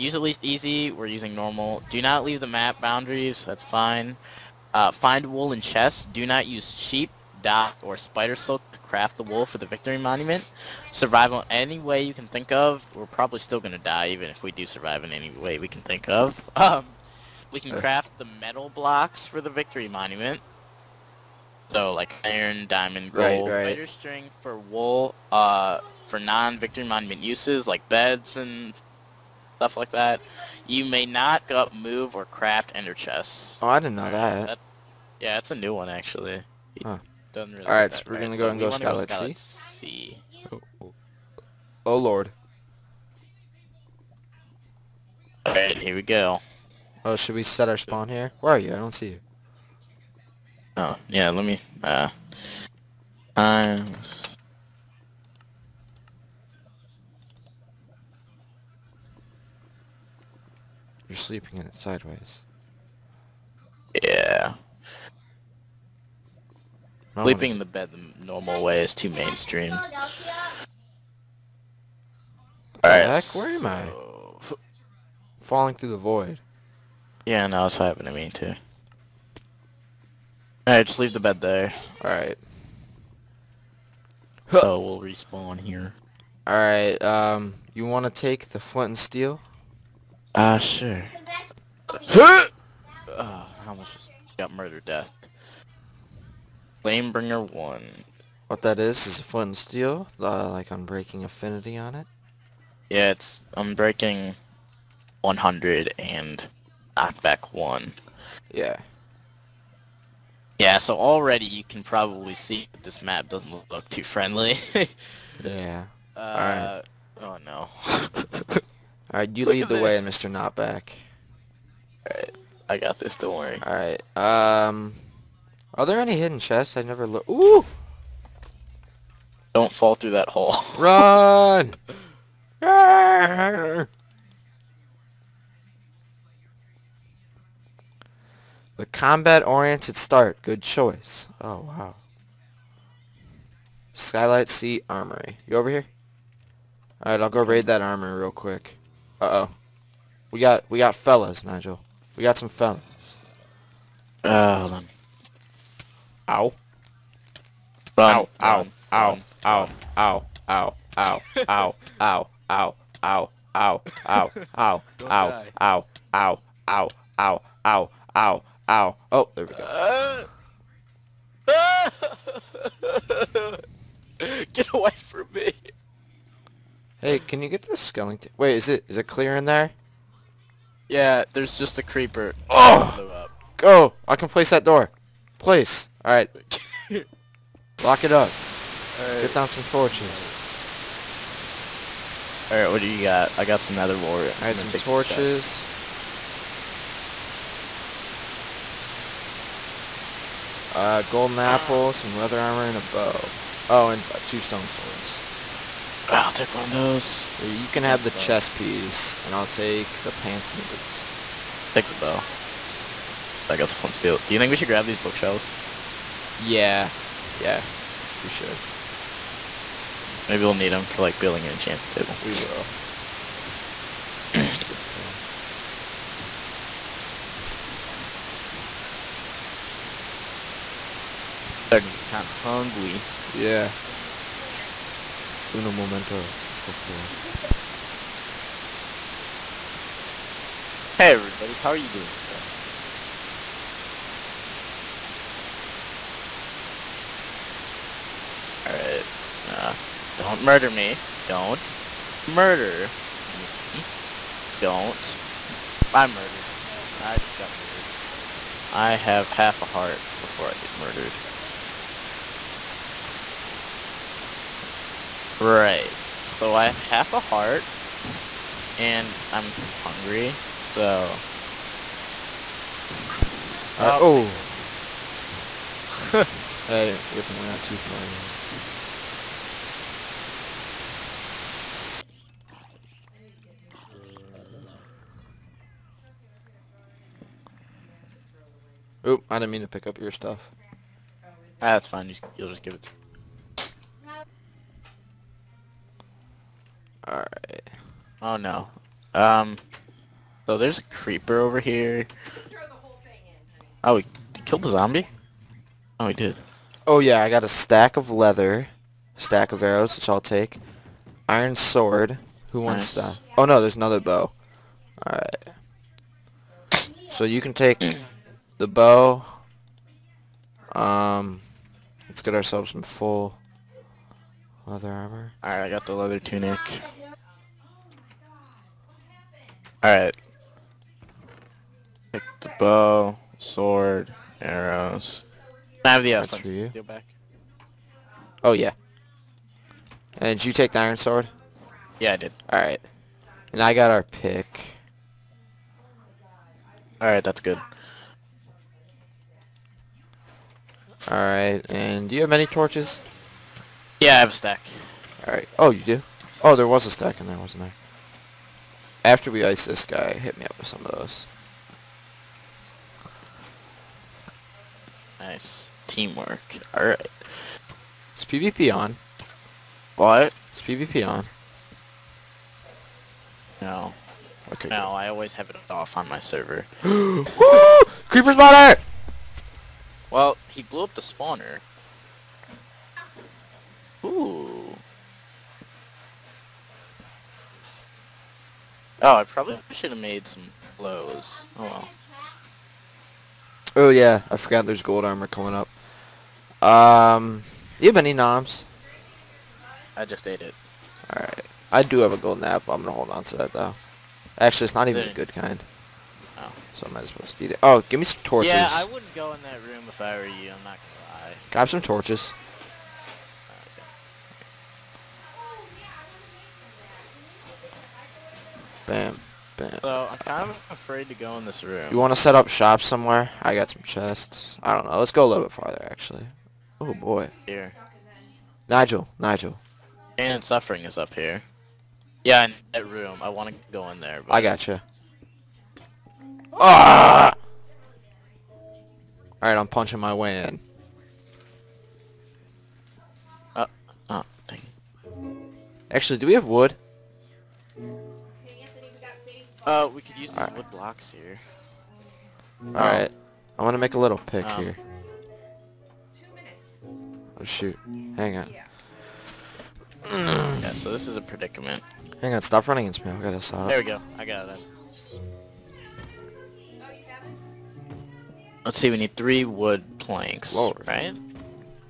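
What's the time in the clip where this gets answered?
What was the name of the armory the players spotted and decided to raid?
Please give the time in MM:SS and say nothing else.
02:23.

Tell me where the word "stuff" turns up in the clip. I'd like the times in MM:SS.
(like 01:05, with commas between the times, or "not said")
00:29, 04:50.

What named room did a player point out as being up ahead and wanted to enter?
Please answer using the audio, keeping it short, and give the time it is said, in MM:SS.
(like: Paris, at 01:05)
Pain and Suffering, at 07:10.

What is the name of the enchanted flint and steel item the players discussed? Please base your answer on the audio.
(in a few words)
Flamebringer 1.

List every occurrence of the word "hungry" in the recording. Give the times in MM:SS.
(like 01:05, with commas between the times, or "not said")
03:52, 04:29.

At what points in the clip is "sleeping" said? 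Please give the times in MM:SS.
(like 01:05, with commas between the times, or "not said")
01:01, 01:07.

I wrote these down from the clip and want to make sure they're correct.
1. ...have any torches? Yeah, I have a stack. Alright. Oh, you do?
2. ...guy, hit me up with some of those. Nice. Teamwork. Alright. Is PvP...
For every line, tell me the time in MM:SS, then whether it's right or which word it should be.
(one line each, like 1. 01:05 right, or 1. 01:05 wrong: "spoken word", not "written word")
1. 05:52 right
2. 05:59 right.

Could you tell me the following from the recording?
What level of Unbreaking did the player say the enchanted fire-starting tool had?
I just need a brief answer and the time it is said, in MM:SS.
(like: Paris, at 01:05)
100, at 01:43.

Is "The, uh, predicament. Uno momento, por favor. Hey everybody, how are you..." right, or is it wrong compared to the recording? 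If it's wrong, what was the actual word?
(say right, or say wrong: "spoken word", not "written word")
wrong: "plant", not "predicament".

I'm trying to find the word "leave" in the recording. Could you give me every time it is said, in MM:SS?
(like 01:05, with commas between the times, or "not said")
00:02, 01:20.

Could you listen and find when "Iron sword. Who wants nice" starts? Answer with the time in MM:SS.
05:11.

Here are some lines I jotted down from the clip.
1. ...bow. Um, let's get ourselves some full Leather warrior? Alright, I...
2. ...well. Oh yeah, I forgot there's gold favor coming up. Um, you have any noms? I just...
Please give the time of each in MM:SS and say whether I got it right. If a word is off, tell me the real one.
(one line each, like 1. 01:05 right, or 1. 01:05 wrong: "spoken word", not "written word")
1. 05:18 wrong: "armor", not "warrior"
2. 06:31 wrong: "armor", not "favor".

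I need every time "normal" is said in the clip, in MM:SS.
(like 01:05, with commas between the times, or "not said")
00:01, 01:08.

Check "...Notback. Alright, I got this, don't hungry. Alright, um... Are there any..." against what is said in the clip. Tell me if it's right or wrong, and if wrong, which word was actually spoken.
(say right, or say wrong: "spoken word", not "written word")
wrong: "worry", not "hungry".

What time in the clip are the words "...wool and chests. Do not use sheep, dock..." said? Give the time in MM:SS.
00:05.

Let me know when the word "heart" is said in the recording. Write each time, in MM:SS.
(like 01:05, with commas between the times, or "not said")
04:19, 04:27.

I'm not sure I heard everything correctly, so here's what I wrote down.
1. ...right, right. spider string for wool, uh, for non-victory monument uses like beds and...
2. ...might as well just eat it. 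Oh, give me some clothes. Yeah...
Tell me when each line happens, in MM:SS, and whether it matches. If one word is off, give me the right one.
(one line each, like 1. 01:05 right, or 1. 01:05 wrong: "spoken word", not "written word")
1. 00:23 right
2. 06:46 wrong: "torches", not "clothes".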